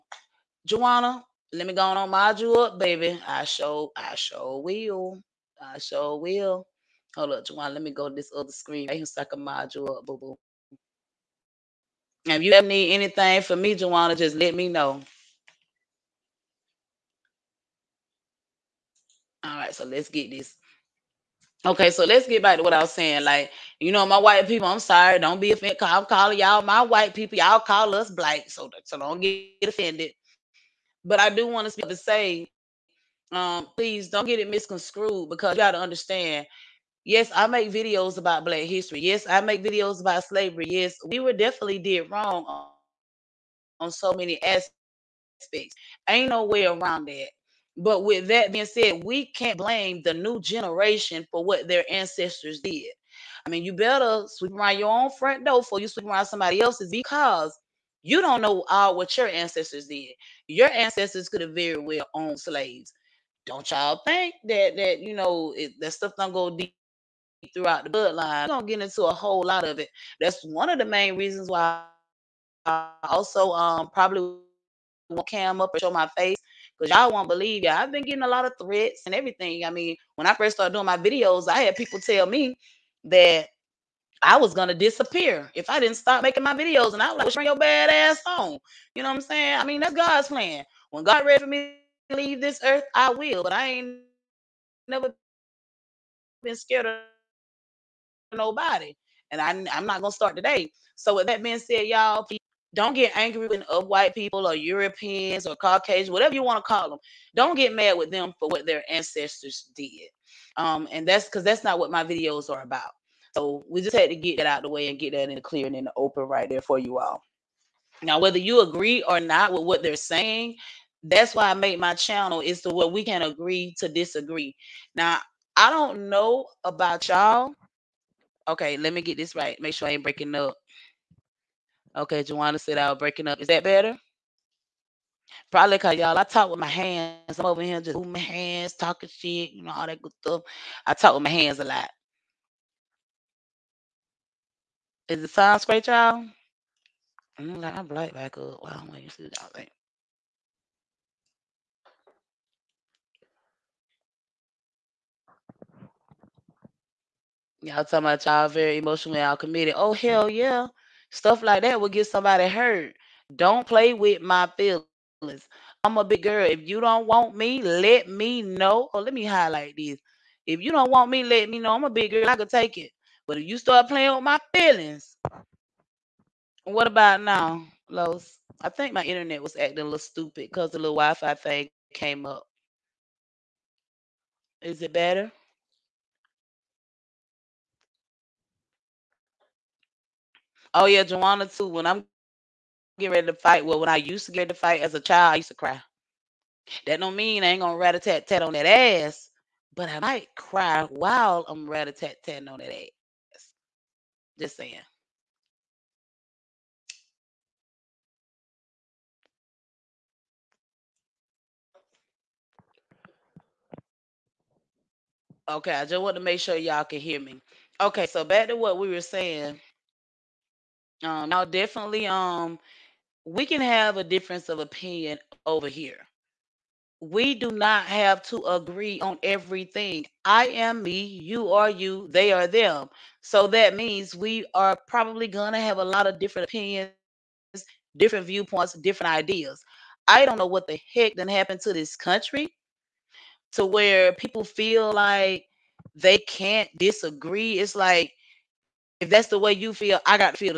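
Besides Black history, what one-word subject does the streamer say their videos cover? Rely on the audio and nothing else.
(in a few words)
Slavery.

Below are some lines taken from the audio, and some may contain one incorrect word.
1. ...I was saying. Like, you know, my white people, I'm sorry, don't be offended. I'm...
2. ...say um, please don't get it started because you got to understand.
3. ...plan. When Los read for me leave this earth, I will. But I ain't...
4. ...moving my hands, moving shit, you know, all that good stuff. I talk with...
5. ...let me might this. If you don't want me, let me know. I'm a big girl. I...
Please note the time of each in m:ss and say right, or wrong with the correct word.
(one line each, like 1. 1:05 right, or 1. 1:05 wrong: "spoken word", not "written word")
1. 0:22 right
2. 0:31 wrong: "misconstrued", not "started"
3. 1:30 wrong: "God", not "Los"
4. 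2:17 wrong: "talking", not "moving"
5. 2:49 wrong: "highlight", not "might".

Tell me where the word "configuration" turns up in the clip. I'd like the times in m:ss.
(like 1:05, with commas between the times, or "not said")
not said.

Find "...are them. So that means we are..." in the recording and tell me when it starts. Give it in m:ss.
3:52.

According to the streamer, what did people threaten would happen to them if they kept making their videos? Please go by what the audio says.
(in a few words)
Disappear.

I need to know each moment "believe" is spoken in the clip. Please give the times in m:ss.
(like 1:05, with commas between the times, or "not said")
1:17.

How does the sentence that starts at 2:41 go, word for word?
Stuff like that will get somebody hurt.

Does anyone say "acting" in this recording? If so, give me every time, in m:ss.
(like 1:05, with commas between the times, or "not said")
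2:59.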